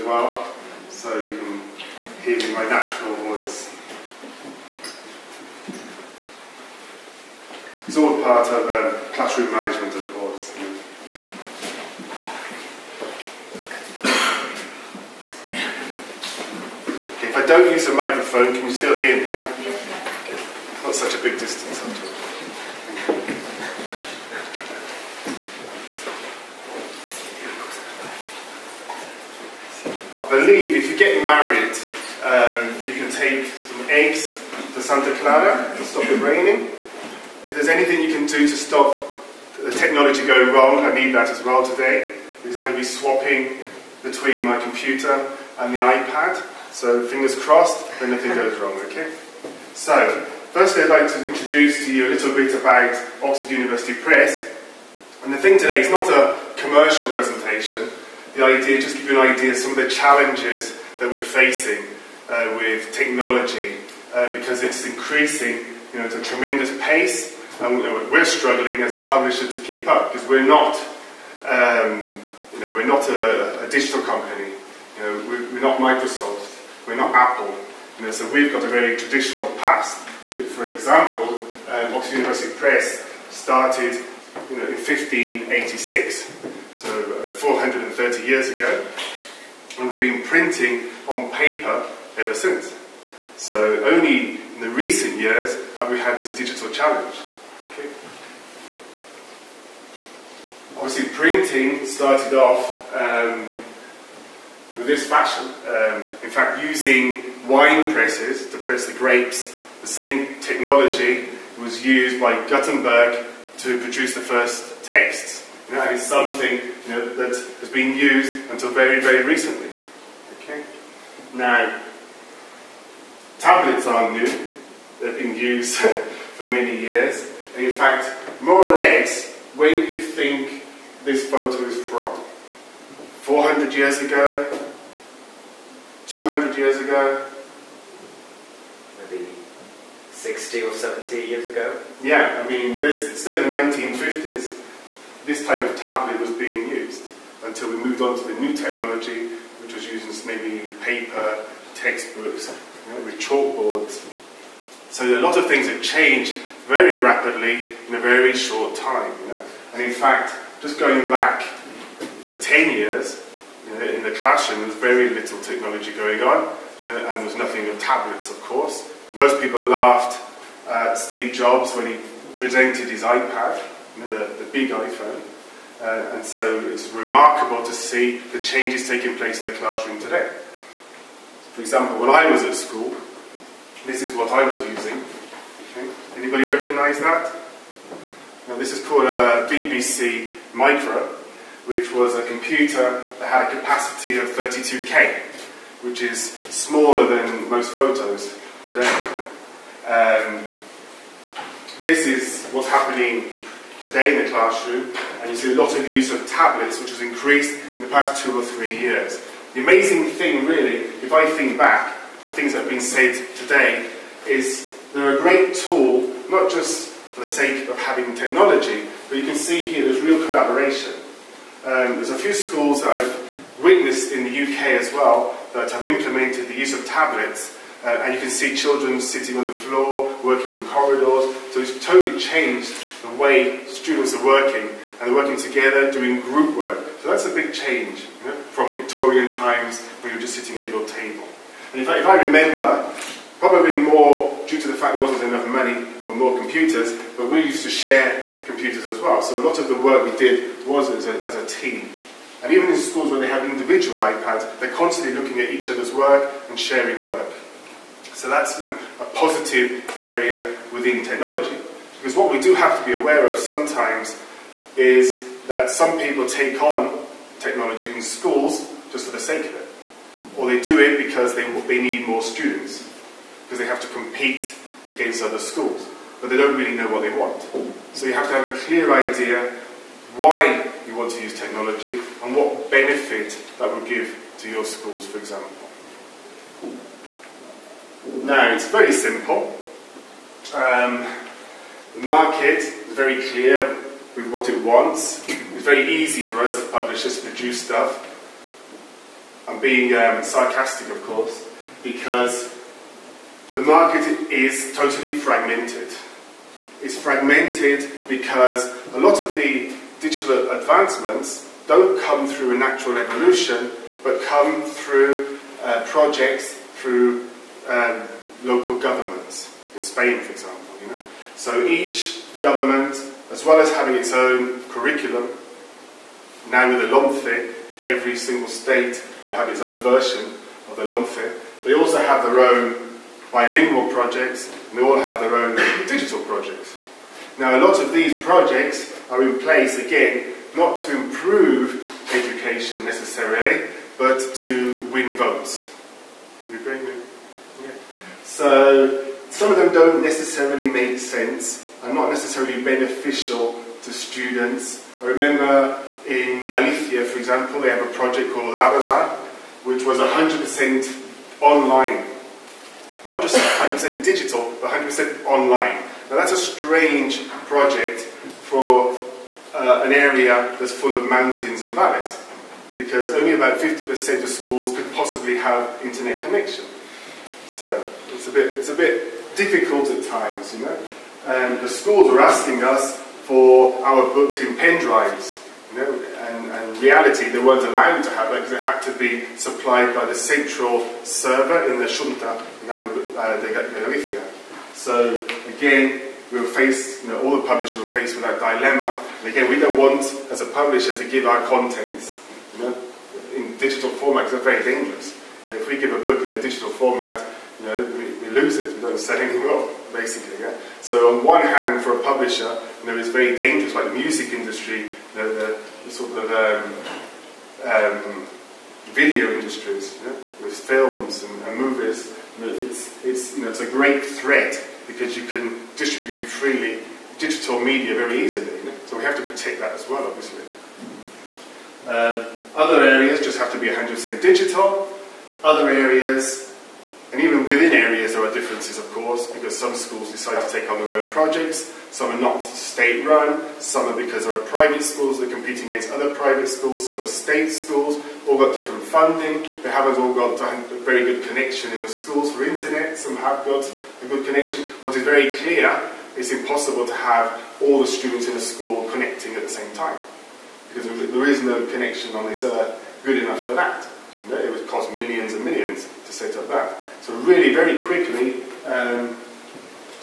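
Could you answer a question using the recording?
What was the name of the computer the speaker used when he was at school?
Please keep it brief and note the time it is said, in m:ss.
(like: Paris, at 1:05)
BBC Micro, at 3:09.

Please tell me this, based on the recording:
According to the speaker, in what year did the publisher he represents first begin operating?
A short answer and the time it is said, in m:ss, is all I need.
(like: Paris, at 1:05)
1586, at 1:24.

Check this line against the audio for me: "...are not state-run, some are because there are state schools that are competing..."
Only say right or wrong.
wrong.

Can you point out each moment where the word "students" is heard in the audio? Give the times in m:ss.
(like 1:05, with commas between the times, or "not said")
3:53, 4:32, 5:53, 7:37.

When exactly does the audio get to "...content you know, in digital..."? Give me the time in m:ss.
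6:41.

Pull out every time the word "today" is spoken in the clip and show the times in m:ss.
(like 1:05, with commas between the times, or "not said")
0:41, 0:55, 3:00, 3:18, 3:23, 3:33.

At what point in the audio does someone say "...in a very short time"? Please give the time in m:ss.
2:37.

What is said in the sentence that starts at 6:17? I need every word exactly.
So it's a bit, it's a bit difficult at times, you know.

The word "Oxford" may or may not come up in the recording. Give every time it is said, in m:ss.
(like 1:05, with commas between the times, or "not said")
0:53, 1:21.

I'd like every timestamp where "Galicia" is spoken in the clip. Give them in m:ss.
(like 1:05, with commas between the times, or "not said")
5:56, 6:33.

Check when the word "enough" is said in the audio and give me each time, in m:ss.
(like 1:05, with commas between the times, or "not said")
4:05, 7:43.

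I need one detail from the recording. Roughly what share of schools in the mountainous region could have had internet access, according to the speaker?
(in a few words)
50%.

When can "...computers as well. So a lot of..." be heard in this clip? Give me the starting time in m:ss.
4:08.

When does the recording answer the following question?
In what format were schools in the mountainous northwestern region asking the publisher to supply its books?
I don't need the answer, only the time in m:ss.
6:24.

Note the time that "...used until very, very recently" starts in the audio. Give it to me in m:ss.
1:57.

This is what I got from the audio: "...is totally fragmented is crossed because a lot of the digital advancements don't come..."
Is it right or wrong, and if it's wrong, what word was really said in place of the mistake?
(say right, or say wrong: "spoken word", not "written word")
wrong: "fragmented", not "crossed".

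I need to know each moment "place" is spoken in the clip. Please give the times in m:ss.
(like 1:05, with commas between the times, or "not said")
2:59, 5:39.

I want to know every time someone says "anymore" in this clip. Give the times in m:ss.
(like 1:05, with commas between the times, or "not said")
6:49.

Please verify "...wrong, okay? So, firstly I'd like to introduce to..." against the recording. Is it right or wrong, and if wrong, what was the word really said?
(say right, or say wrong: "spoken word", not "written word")
right.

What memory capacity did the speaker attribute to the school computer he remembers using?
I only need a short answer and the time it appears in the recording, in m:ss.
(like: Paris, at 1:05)
32K, at 3:14.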